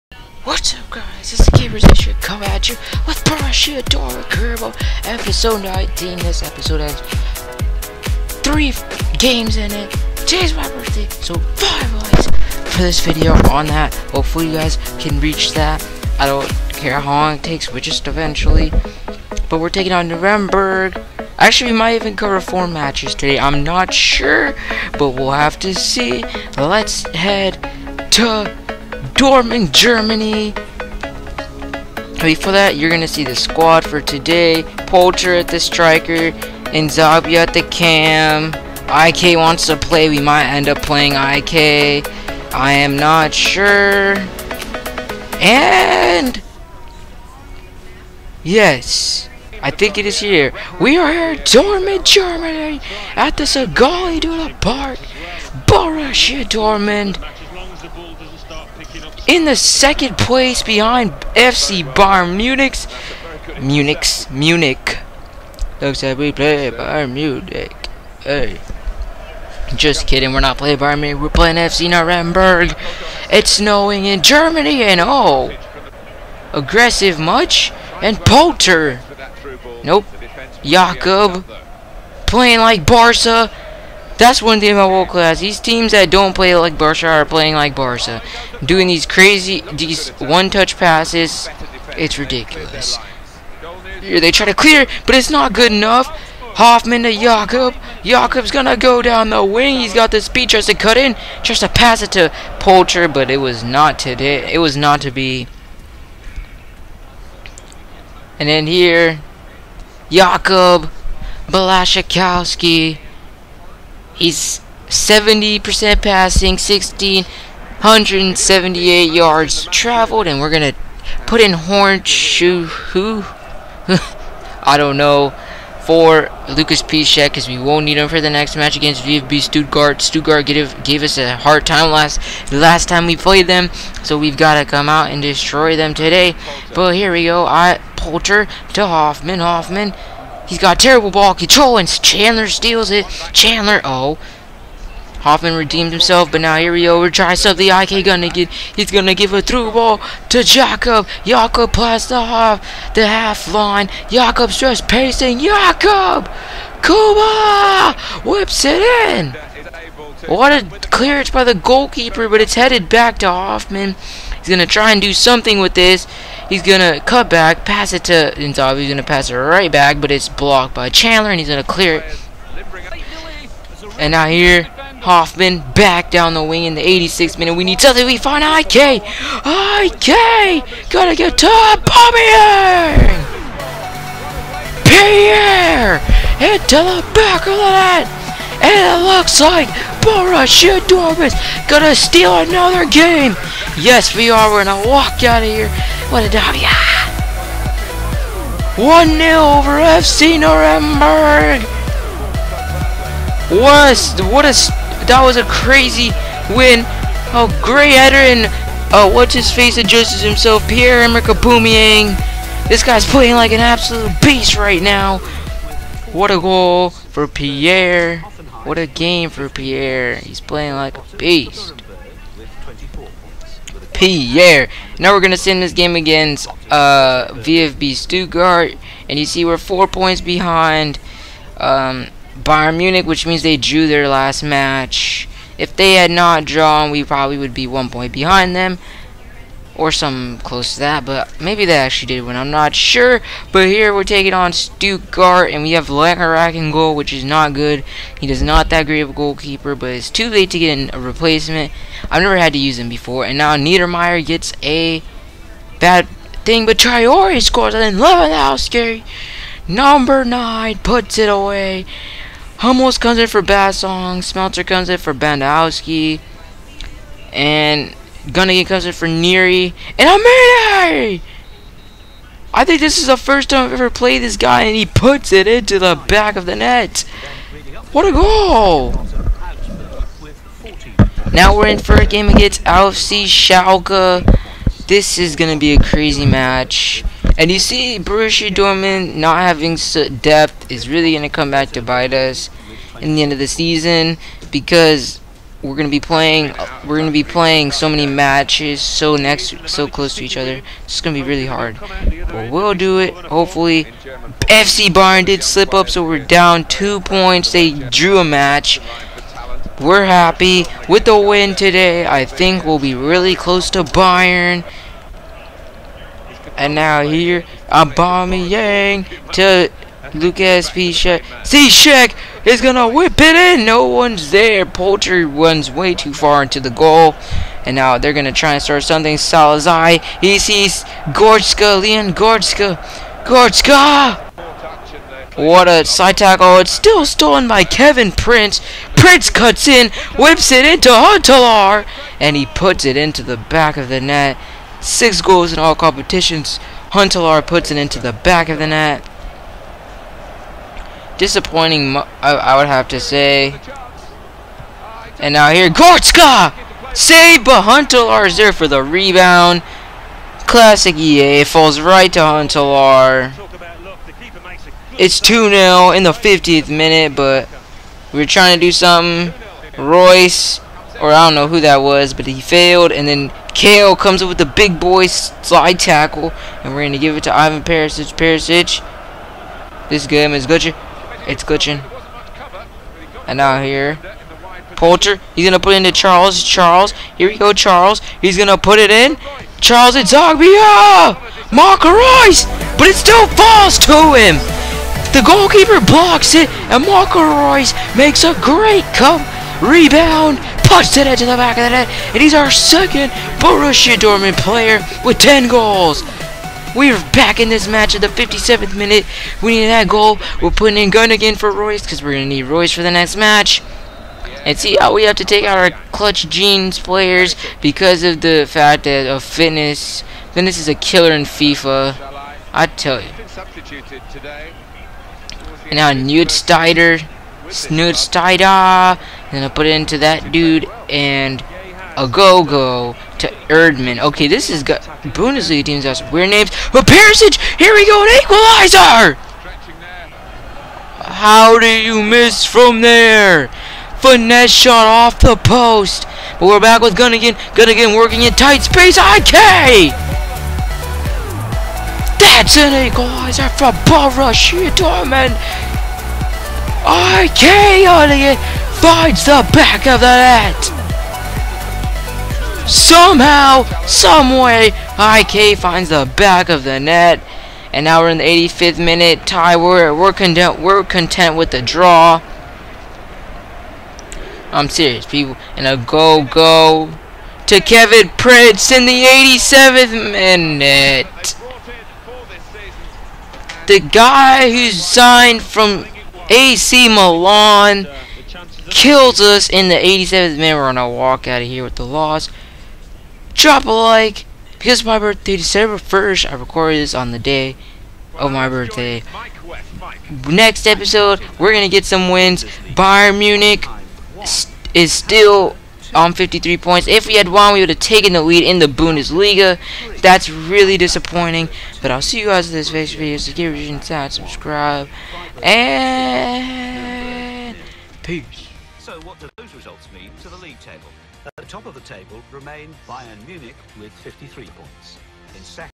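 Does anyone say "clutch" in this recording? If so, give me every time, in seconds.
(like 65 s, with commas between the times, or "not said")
415 s.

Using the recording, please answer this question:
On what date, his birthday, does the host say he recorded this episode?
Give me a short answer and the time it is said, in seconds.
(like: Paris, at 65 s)
December 1st, at 495 s.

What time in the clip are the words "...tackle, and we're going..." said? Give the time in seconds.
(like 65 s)
375 s.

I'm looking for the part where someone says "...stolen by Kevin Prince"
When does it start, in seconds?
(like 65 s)
337 s.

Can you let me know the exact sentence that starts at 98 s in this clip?
Jakob's gonna go down the wing.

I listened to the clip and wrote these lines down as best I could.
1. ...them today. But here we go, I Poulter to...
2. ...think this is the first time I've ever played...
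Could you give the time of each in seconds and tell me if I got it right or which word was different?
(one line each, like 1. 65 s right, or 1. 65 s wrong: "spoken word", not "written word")
1. 135 s right
2. 272 s right.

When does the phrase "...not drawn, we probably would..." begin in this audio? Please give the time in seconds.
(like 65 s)
236 s.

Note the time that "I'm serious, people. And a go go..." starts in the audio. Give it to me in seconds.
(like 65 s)
474 s.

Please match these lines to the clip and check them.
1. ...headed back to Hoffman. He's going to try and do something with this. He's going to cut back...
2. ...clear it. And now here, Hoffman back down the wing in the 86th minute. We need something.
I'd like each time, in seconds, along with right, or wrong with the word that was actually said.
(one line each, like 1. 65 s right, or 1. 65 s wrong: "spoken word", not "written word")
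1. 162 s right
2. 171 s right.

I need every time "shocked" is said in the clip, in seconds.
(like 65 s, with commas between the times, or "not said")
not said.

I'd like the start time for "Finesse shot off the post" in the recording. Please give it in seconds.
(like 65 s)
443 s.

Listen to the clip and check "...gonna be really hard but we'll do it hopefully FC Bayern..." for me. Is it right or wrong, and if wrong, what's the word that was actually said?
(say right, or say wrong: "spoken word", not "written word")
right.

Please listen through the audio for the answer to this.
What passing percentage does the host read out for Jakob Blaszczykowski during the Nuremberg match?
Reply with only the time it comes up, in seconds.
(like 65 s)
114 s.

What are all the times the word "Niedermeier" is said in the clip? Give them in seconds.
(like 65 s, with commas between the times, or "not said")
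253 s.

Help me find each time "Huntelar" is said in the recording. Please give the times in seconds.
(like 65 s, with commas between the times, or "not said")
340 s, 346 s, 357 s, 362 s.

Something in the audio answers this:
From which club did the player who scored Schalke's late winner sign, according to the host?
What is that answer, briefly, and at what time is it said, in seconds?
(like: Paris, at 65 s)
AC Milan, at 486 s.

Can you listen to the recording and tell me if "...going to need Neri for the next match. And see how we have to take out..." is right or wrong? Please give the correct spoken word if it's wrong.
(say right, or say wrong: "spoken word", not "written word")
wrong: "Reus", not "Neri".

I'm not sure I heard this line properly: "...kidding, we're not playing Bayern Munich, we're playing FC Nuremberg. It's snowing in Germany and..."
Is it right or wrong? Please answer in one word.
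right.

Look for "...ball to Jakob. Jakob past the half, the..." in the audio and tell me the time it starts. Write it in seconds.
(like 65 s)
149 s.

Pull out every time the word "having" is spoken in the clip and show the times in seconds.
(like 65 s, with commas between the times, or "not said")
289 s.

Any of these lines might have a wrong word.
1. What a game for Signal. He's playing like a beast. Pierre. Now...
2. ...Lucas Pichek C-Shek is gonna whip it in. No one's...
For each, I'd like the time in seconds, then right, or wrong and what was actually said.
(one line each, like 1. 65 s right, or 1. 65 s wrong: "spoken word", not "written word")
1. 218 s wrong: "Pierre", not "Signal"
2. 320 s right.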